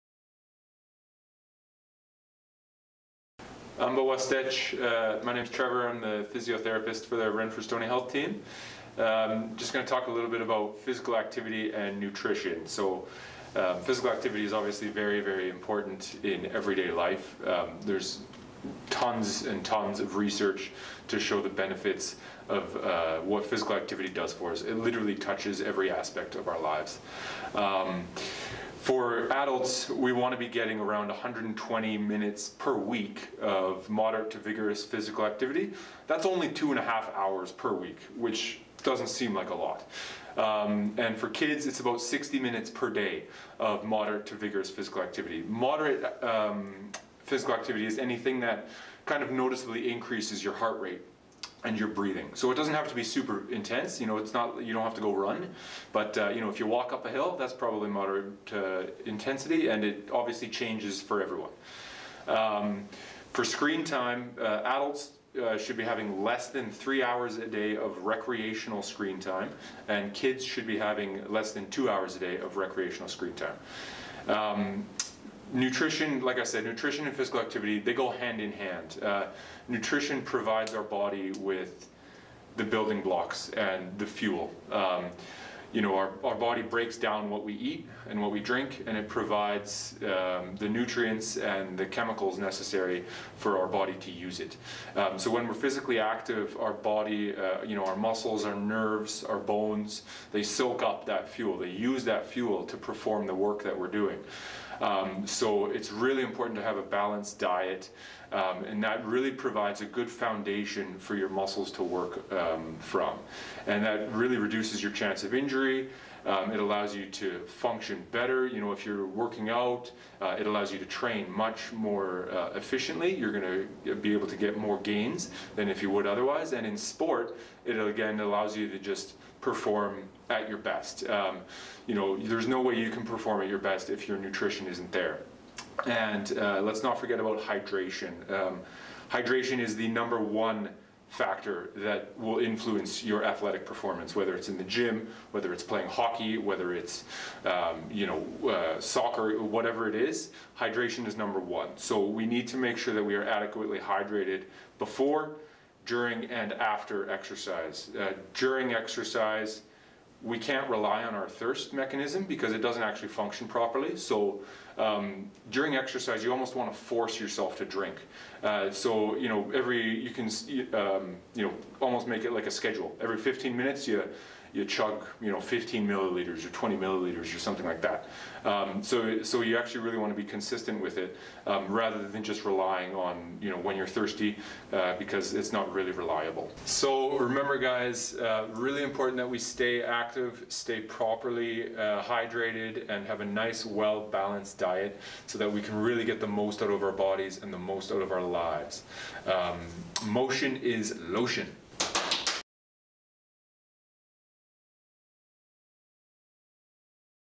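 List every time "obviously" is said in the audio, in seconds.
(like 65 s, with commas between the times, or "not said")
14 s, 60 s.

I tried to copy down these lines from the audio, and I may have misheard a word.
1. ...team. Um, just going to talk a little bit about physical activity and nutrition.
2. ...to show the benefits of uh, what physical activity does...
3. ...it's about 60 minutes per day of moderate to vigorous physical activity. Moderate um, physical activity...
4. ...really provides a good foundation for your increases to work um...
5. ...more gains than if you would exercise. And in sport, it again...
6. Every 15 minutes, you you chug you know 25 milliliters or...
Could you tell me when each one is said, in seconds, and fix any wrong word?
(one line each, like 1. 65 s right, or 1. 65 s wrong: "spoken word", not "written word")
1. 8 s right
2. 21 s right
3. 41 s right
4. 109 s wrong: "muscles", not "increases"
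5. 124 s wrong: "otherwise", not "exercise"
6. 173 s wrong: "15", not "25".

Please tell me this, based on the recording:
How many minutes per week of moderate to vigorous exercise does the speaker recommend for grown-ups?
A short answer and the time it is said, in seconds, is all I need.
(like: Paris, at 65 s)
120, at 31 s.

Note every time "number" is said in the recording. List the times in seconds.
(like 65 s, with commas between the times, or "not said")
139 s, 151 s.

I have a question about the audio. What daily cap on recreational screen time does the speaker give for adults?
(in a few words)
less than 3 hours.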